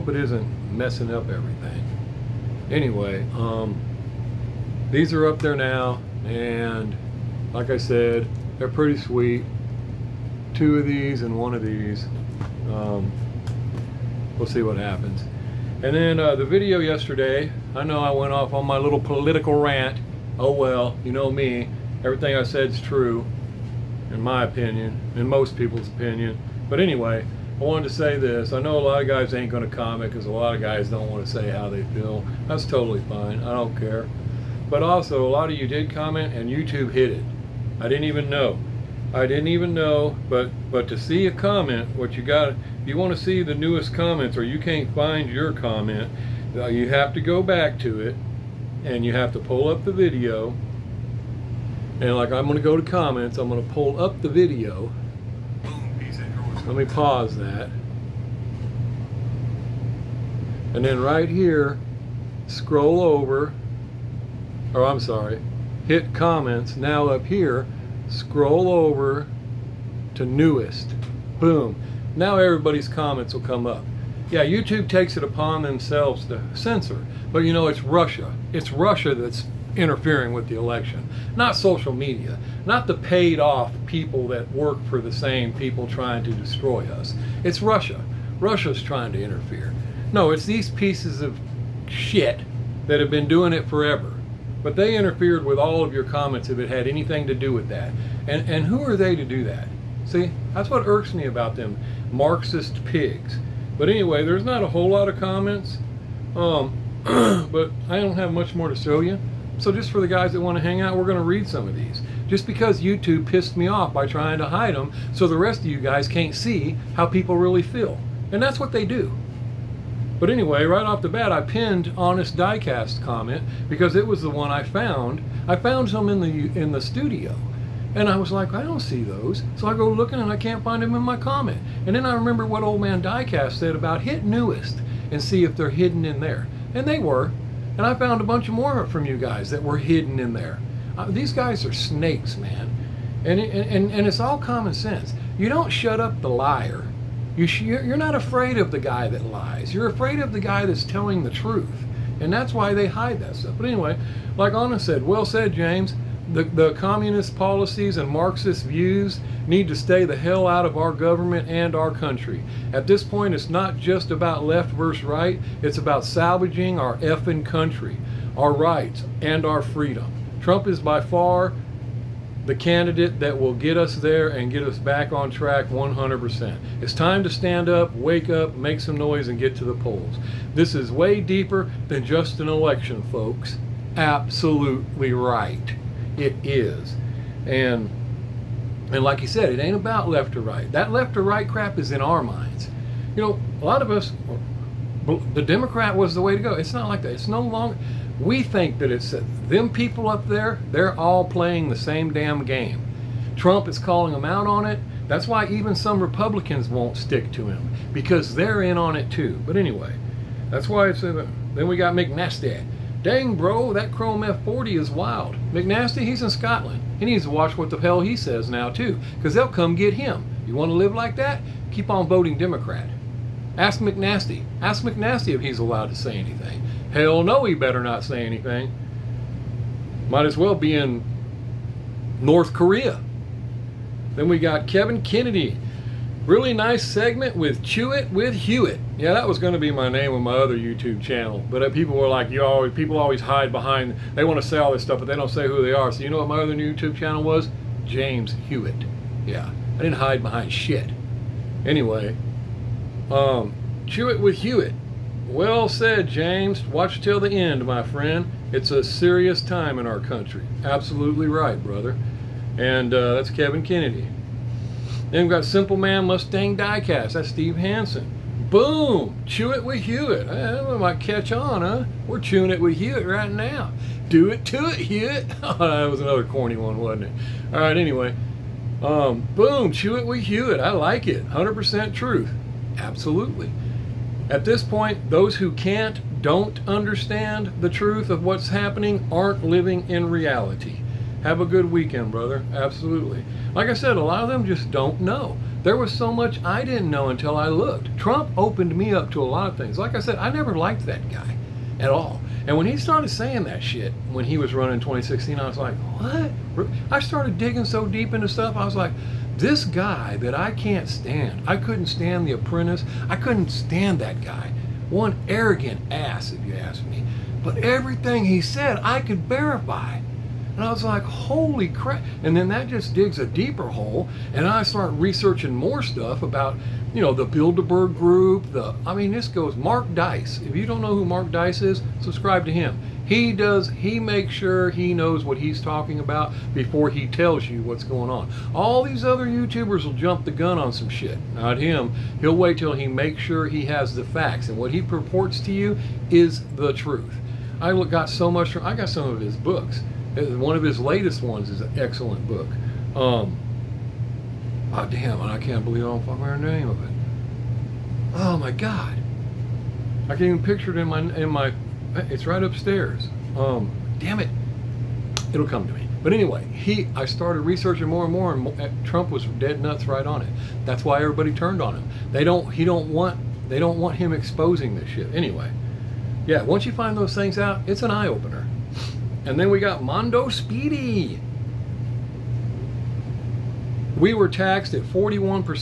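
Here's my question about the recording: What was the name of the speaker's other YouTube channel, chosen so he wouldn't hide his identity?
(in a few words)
James Hewitt.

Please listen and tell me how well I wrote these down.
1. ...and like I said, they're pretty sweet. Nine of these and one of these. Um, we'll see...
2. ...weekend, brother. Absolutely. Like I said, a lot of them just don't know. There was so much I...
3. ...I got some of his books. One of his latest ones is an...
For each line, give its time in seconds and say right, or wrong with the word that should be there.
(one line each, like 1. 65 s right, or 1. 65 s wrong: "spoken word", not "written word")
1. 6 s wrong: "Two", not "Nine"
2. 291 s right
3. 348 s right.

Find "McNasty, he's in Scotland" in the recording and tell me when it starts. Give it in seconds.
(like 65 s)
215 s.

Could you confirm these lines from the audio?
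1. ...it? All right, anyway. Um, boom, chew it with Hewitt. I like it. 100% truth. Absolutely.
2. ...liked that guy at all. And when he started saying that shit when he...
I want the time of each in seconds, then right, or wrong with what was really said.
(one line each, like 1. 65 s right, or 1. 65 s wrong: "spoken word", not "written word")
1. 277 s right
2. 300 s right.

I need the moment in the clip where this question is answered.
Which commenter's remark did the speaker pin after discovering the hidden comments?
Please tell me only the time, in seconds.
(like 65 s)
121 s.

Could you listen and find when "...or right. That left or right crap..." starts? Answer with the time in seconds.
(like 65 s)
190 s.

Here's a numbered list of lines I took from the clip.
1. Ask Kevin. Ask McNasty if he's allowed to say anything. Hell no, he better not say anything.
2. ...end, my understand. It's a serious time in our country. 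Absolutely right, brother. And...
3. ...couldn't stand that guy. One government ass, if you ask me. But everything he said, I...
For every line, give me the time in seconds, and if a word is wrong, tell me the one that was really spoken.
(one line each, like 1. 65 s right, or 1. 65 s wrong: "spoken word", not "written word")
1. 223 s wrong: "McNasty", not "Kevin"
2. 257 s wrong: "friend", not "understand"
3. 313 s wrong: "arrogant", not "government".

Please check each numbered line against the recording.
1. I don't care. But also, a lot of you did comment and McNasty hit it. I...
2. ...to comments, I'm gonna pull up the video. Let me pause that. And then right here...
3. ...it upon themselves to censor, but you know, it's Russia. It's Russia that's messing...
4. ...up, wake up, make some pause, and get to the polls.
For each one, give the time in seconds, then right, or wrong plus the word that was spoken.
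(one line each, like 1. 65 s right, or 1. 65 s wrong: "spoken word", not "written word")
1. 33 s wrong: "YouTube", not "McNasty"
2. 52 s right
3. 75 s wrong: "interfering", not "messing"
4. 177 s wrong: "noise", not "pause".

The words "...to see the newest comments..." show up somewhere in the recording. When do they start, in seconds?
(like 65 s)
43 s.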